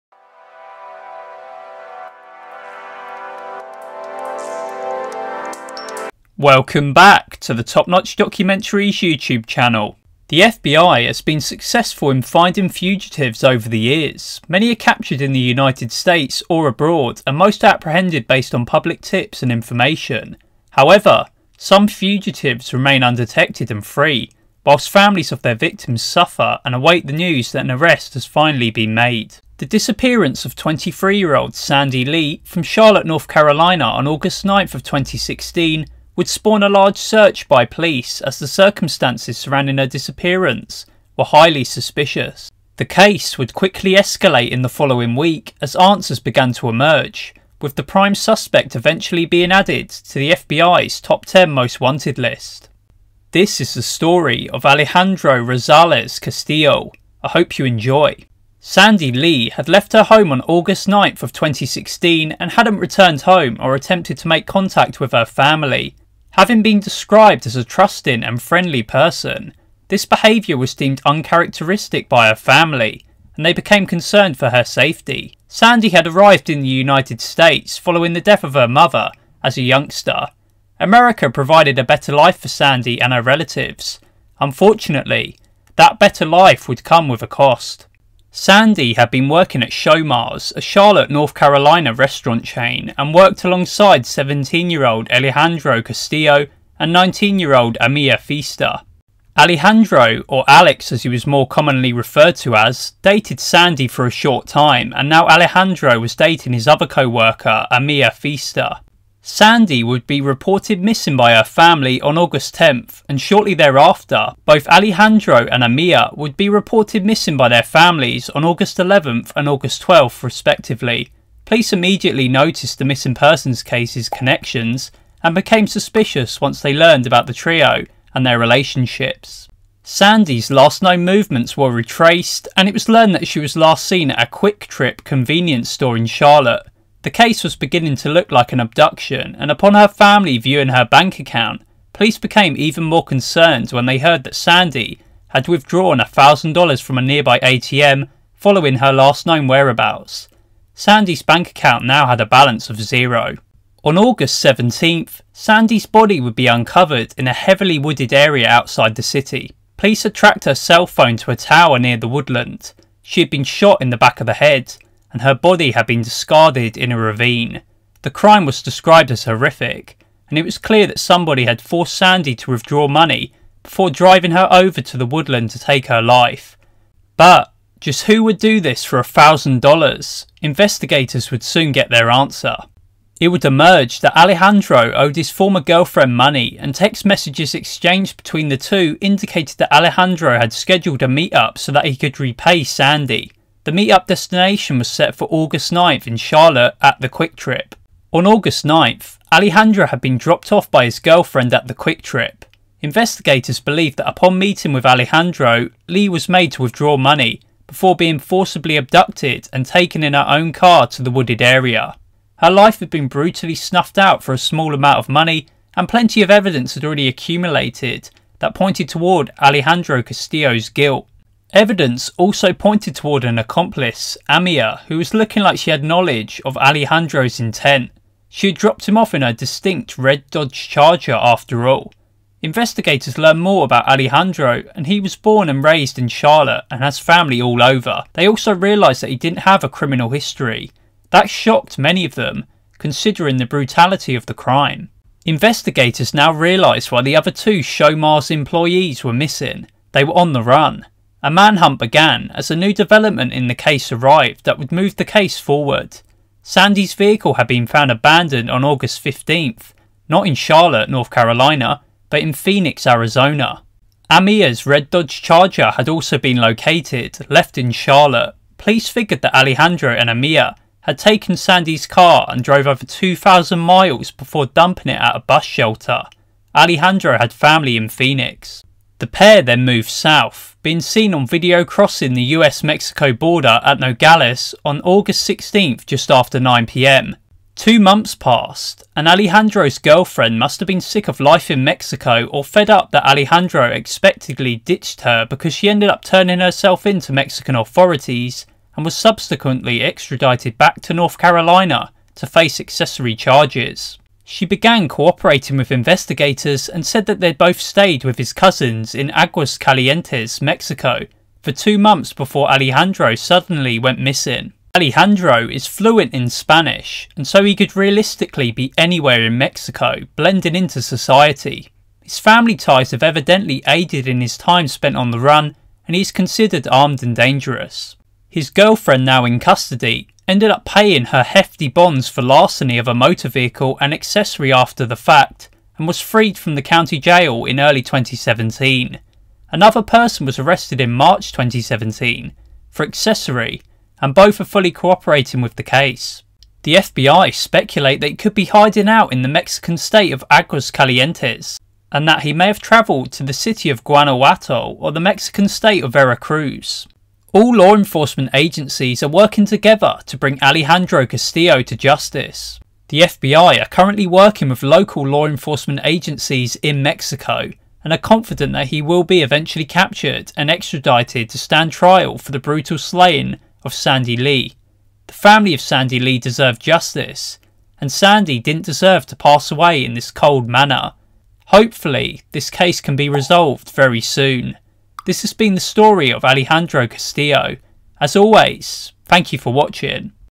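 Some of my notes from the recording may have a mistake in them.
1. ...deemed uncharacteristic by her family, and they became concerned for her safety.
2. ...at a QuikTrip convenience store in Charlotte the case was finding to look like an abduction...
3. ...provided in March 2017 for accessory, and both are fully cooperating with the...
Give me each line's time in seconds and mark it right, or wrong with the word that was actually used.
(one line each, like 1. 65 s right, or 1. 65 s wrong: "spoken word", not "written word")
1. 70 s right
2. 134 s wrong: "beginning", not "finding"
3. 340 s wrong: "arrested", not "provided".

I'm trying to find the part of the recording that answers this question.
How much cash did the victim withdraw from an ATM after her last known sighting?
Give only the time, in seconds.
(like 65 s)
145 s.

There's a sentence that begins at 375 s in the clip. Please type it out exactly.
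The family of Sandy Le deserved justice, and Sandy didn't deserve to pass away in this cold manner.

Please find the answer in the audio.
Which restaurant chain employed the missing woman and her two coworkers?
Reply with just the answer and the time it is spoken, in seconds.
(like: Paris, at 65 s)
Showmars, at 89 s.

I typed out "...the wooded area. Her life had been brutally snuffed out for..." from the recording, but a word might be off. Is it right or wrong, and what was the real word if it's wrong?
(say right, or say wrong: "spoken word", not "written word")
right.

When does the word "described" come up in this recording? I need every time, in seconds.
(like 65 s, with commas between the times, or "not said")
66 s, 168 s.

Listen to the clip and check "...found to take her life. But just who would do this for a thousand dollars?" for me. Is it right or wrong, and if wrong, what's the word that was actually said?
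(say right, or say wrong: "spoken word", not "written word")
wrong: "woodland", not "found".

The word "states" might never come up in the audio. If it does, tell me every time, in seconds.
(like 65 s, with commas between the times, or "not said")
15 s, 77 s, 349 s, 355 s.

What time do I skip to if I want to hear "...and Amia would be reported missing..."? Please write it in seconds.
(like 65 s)
115 s.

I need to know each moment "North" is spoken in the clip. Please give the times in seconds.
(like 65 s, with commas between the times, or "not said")
33 s, 91 s, 260 s, 300 s.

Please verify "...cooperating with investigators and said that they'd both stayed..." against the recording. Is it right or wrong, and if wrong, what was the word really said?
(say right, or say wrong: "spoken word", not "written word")
right.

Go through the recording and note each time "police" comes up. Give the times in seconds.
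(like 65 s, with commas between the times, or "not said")
37 s, 121 s, 141 s, 159 s, 268 s.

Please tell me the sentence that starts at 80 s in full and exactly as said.
America provided a better life for Sandy and her relatives.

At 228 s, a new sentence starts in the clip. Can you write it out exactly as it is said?
She had dropped him off in her distinct red Dodge Charger after all.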